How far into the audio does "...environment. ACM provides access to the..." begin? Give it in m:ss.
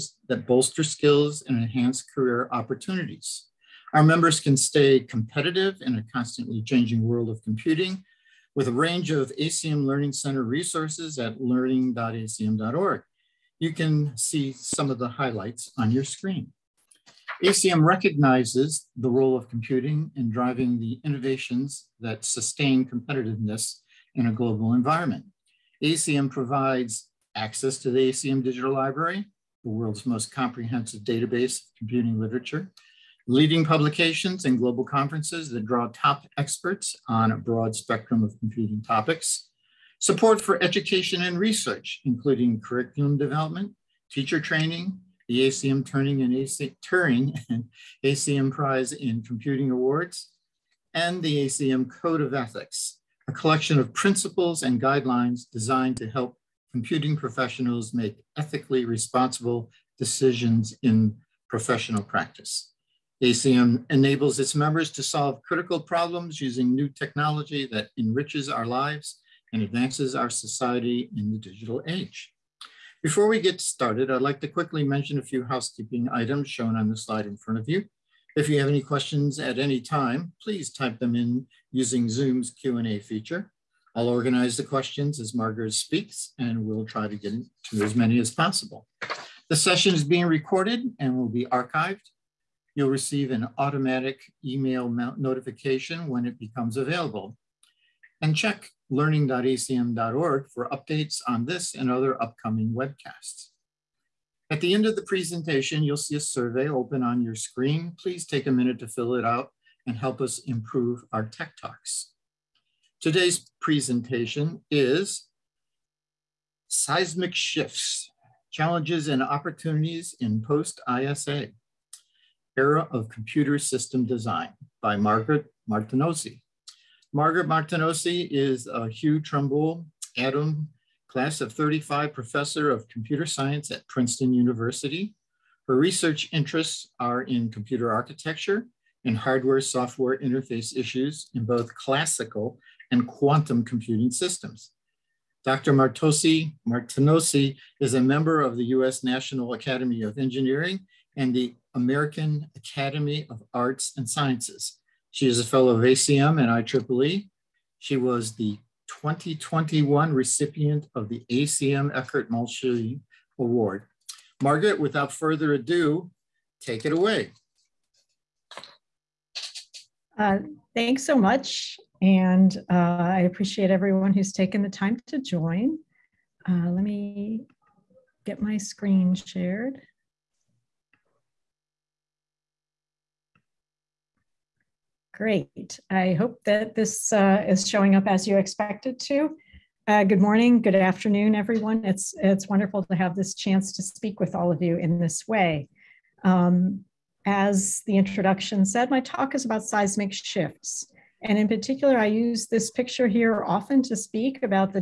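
0:24.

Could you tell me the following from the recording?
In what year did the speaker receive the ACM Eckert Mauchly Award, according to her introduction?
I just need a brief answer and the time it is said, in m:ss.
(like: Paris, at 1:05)
2021, at 2:39.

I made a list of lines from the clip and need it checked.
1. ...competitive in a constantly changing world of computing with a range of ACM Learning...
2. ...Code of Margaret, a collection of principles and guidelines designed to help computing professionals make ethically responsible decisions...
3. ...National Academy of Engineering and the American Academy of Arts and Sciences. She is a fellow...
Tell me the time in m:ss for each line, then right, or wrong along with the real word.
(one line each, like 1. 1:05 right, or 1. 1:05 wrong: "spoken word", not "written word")
1. 0:05 right
2. 0:51 wrong: "Ethics", not "Margaret"
3. 2:29 right.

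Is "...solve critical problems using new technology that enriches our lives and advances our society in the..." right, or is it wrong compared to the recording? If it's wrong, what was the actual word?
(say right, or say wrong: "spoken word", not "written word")
right.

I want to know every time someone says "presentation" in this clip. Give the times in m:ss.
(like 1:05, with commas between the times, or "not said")
1:45, 1:53.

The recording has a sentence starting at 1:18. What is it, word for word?
If you have any questions at any time, please type them in using Zoom's Q&A feature.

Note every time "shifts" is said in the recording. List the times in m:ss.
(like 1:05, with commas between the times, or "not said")
1:57, 3:20.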